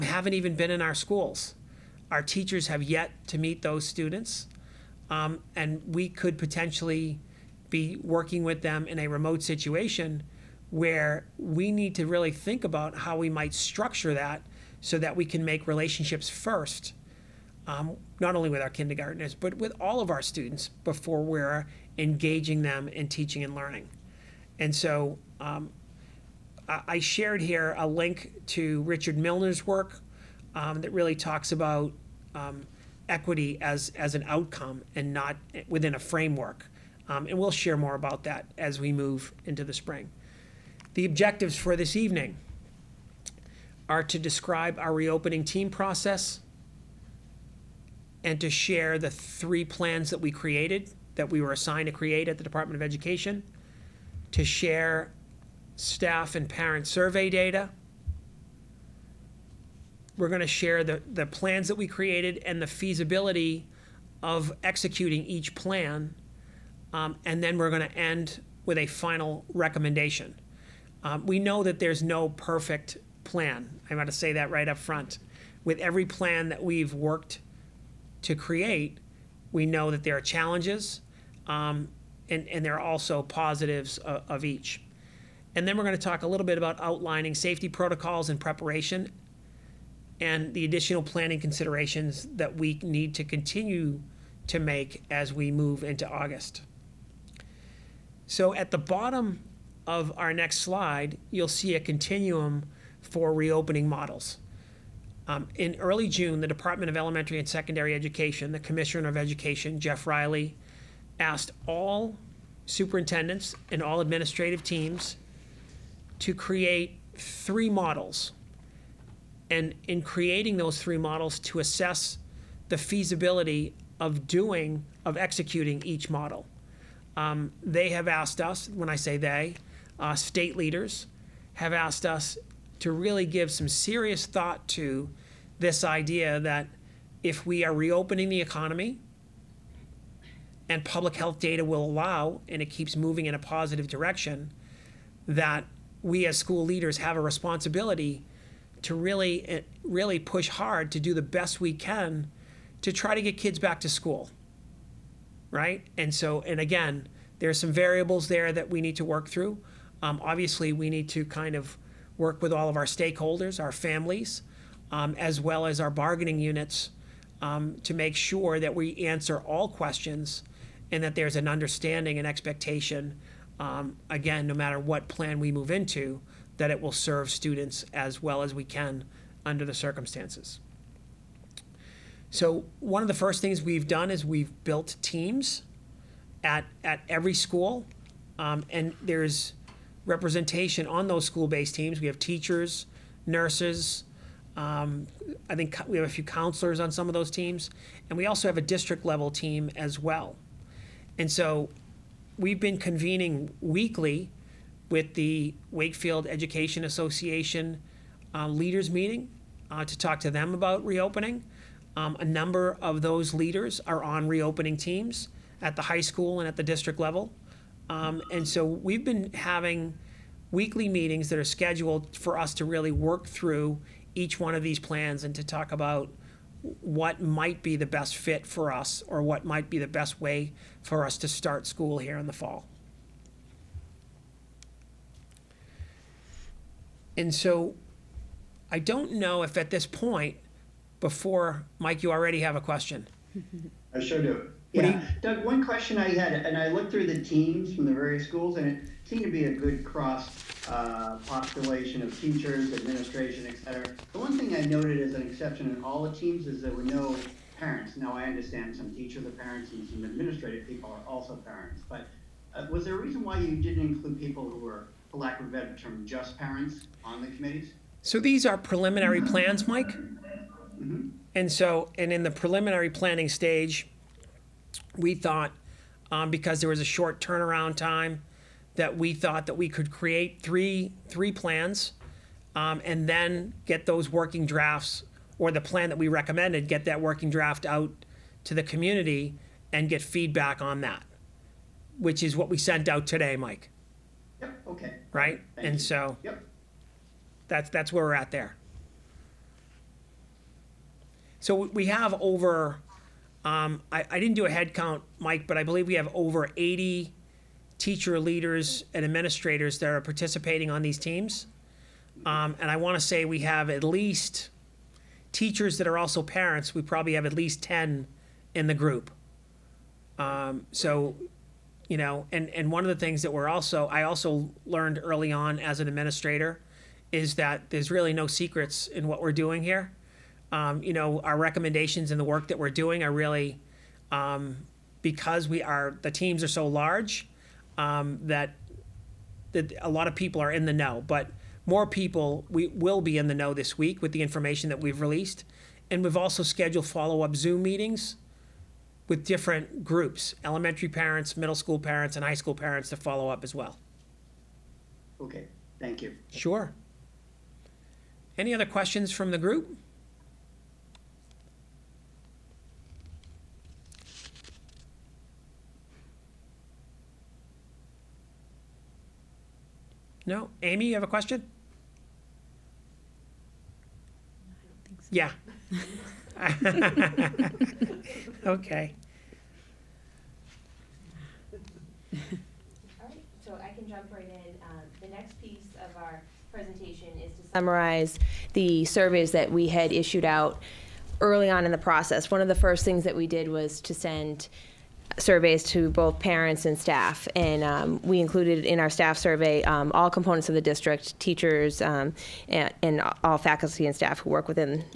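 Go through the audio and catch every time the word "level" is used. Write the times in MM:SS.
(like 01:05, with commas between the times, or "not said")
03:18, 03:36.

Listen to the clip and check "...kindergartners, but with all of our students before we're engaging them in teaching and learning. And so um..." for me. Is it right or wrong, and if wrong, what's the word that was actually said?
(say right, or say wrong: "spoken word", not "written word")
right.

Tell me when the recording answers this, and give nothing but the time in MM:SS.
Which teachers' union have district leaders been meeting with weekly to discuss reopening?
03:25.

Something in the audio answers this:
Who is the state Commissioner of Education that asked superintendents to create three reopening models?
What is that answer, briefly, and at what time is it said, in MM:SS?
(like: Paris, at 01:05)
Jeff Riley, at 01:49.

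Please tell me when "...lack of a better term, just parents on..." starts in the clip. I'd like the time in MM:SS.
04:25.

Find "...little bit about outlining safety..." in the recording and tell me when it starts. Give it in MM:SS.
01:26.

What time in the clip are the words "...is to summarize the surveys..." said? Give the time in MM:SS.
06:27.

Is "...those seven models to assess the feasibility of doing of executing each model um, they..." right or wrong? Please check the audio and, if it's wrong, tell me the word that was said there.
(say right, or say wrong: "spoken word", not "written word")
wrong: "three", not "seven".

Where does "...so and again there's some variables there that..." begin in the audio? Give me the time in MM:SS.
02:36.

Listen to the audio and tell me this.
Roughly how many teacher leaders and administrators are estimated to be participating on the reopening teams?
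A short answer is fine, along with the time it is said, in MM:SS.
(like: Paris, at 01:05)
over 80, at 05:06.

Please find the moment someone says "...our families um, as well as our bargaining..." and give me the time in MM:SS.
02:43.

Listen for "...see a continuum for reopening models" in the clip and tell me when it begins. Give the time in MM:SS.
01:41.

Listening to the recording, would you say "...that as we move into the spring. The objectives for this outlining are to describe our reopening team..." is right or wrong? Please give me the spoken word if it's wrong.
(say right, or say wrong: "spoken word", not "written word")
wrong: "evening", not "outlining".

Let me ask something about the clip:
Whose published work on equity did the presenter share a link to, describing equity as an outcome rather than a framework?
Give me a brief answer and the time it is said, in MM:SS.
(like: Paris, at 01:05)
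Richard Milner, at 00:28.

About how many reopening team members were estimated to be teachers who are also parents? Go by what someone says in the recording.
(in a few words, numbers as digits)
10.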